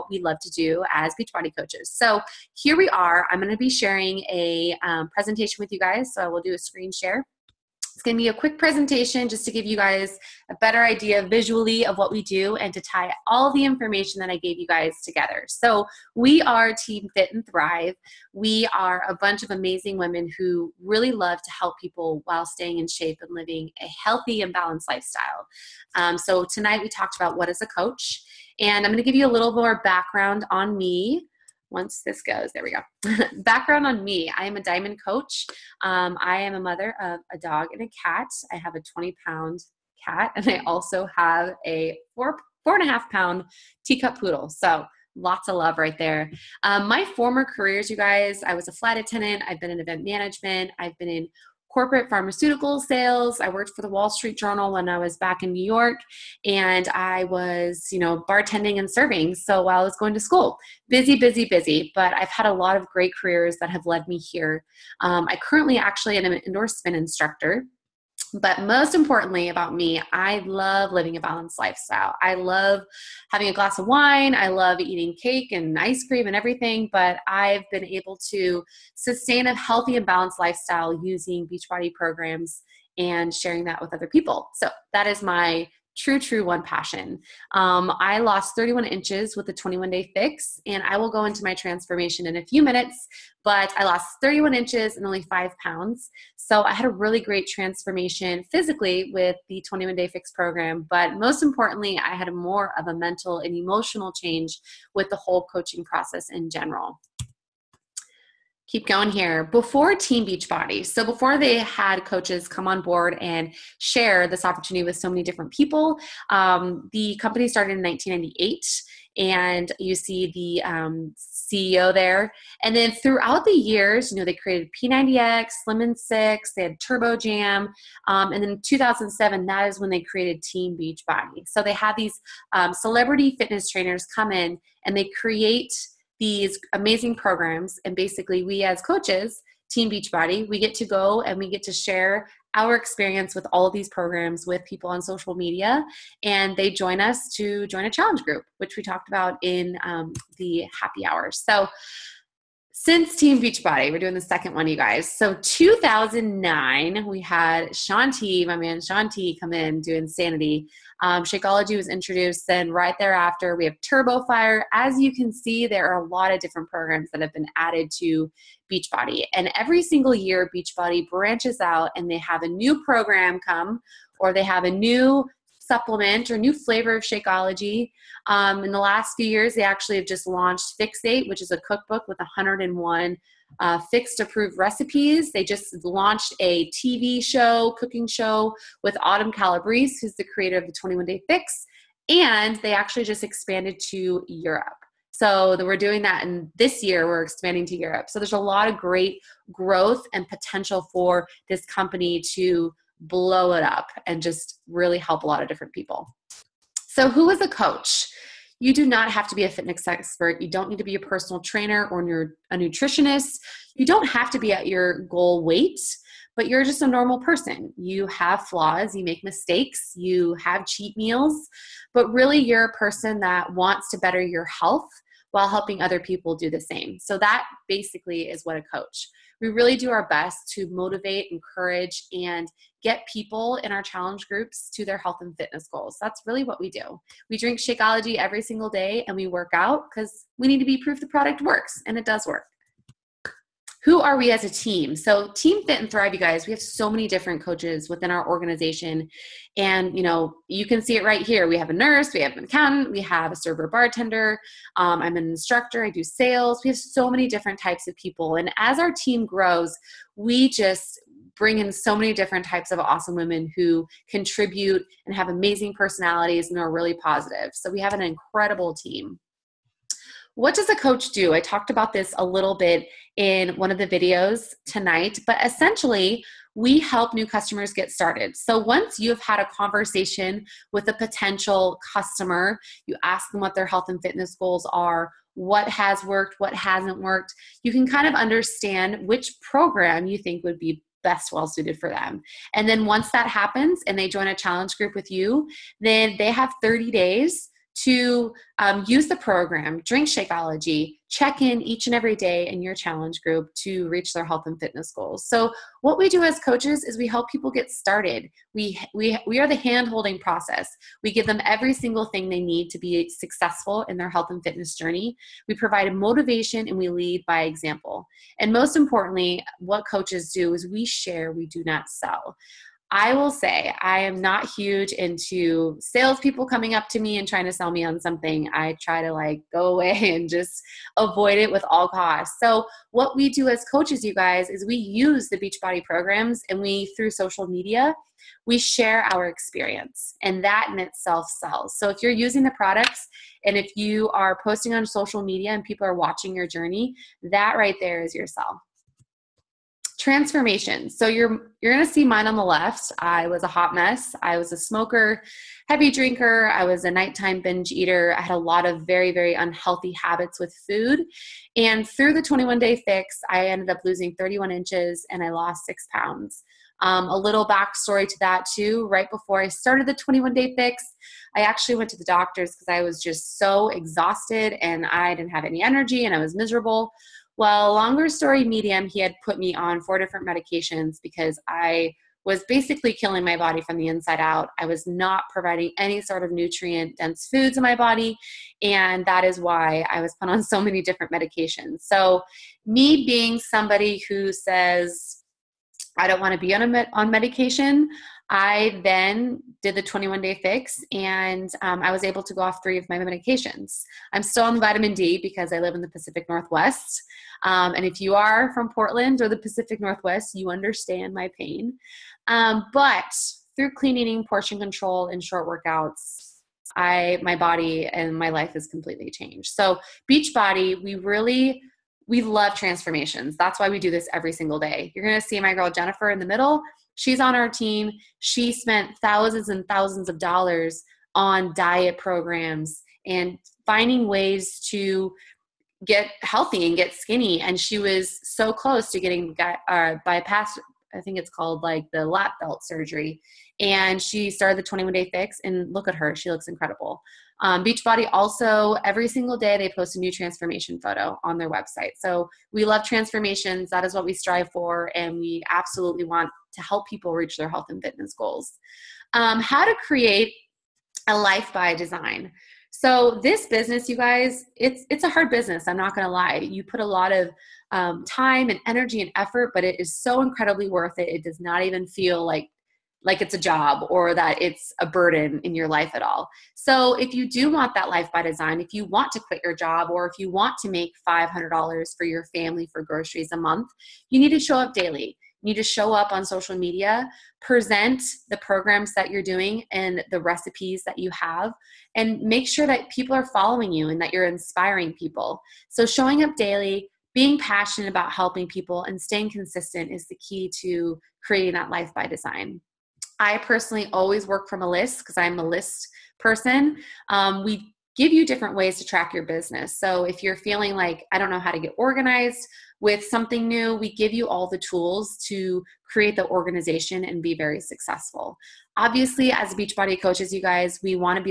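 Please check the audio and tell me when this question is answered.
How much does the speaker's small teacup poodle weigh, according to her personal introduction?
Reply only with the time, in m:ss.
0:42.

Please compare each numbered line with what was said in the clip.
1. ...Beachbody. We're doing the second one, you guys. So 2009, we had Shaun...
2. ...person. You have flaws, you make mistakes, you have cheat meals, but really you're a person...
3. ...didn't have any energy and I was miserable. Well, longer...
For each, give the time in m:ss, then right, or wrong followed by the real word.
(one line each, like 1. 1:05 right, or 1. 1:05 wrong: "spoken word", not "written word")
1. 2:33 right
2. 3:37 right
3. 6:15 right.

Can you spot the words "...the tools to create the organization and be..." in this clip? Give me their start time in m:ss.
8:34.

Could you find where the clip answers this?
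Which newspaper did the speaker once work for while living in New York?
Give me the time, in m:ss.
0:53.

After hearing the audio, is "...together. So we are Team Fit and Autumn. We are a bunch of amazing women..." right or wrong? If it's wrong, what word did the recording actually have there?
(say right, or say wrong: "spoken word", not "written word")
wrong: "Thrive", not "Autumn".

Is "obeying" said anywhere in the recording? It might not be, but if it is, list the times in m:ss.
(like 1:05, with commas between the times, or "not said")
not said.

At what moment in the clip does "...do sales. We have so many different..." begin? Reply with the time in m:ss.
4:15.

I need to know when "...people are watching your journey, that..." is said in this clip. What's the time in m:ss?
5:45.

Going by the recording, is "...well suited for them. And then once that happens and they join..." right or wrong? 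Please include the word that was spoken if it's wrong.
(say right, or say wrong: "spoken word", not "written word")
right.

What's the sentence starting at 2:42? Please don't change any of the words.
Then right thereafter, we have Turbo Fire.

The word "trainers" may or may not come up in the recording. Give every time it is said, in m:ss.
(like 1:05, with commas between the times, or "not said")
2:13, 3:31.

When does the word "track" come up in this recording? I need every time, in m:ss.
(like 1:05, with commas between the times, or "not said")
8:28.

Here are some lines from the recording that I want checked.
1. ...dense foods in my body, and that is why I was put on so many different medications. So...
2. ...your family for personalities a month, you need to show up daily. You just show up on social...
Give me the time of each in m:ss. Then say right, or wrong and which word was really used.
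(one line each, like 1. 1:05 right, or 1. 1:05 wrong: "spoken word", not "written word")
1. 6:26 right
2. 8:02 wrong: "groceries", not "personalities".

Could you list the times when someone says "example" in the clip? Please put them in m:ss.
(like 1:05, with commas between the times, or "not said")
5:17.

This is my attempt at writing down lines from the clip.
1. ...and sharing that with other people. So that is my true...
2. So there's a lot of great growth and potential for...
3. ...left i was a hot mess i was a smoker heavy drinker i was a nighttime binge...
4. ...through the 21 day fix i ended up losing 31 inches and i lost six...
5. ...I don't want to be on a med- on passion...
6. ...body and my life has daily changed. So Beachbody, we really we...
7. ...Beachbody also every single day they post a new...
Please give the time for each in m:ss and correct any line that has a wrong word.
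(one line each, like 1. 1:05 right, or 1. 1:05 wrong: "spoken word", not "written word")
1. 1:22 right
2. 3:18 right
3. 5:52 right
4. 6:01 right
5. 6:35 wrong: "medication", not "passion"
6. 6:57 wrong: "completely", not "daily"
7. 7:27 right.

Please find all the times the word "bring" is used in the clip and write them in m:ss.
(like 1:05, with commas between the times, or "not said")
4:21.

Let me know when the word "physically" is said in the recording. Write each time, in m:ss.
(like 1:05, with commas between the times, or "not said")
1:38.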